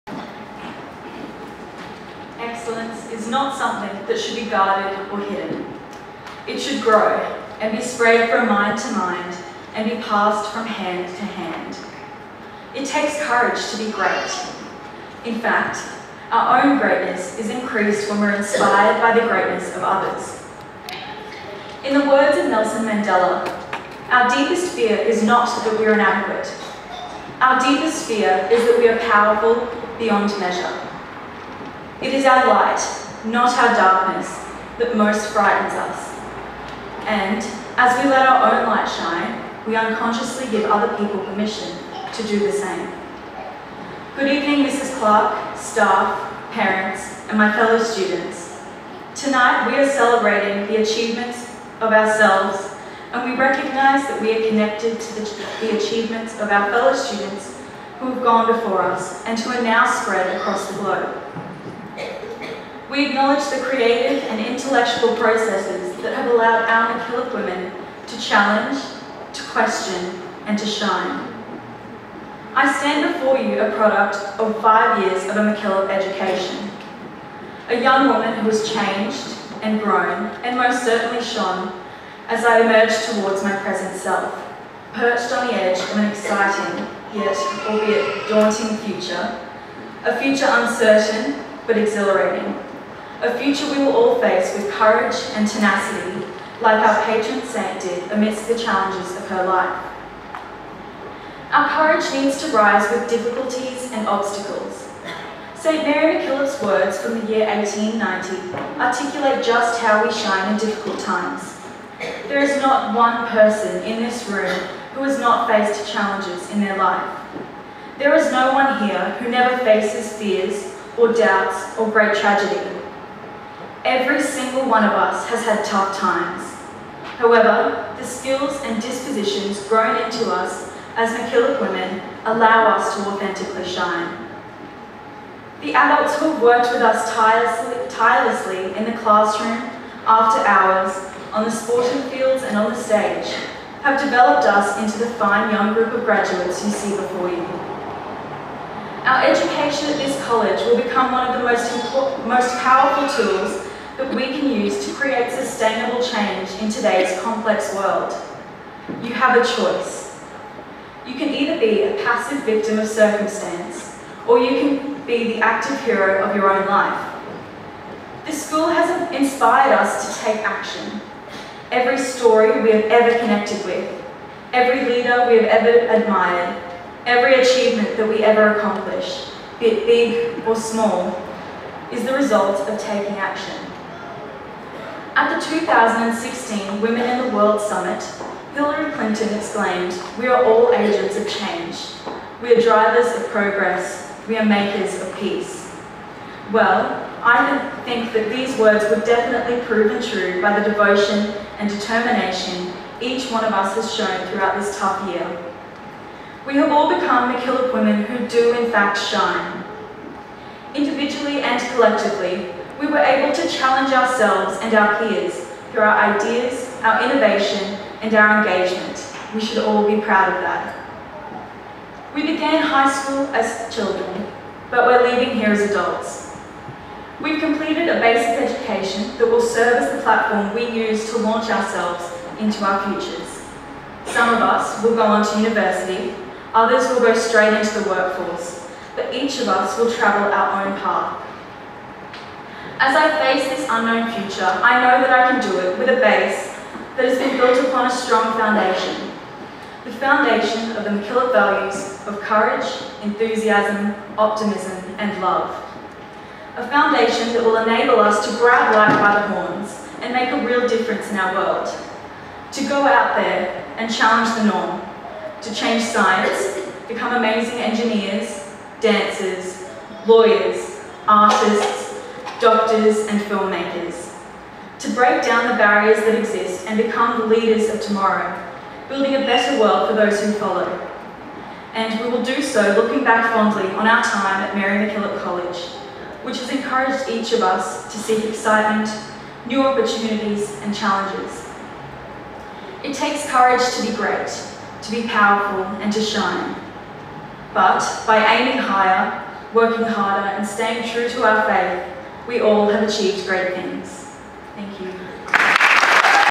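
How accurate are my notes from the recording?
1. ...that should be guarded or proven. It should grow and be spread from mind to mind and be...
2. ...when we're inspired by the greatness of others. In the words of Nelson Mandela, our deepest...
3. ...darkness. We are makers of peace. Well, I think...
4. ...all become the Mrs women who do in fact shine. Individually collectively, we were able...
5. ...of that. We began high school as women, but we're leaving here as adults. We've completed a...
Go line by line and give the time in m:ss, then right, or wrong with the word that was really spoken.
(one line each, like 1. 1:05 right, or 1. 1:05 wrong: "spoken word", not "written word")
1. 0:04 wrong: "hidden", not "proven"
2. 0:18 right
3. 3:13 wrong: "progress", not "darkness"
4. 3:26 wrong: "MacKillop", not "Mrs"
5. 3:40 wrong: "children", not "women".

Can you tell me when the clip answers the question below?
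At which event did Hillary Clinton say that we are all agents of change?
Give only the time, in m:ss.
3:05.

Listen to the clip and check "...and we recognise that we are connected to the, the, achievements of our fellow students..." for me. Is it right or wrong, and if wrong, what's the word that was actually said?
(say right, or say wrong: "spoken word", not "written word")
right.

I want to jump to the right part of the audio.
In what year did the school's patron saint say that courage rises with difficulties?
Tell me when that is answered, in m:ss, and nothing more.
1:47.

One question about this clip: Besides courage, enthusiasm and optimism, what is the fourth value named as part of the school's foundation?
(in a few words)
love.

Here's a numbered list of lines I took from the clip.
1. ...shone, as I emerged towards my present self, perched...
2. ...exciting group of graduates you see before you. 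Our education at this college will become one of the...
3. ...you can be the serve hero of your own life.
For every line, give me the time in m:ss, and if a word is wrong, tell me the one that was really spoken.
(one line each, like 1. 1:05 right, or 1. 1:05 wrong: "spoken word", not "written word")
1. 1:21 right
2. 2:25 wrong: "young", not "exciting"
3. 2:44 wrong: "active", not "serve".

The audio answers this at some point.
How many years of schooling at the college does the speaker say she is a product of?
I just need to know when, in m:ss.
1:14.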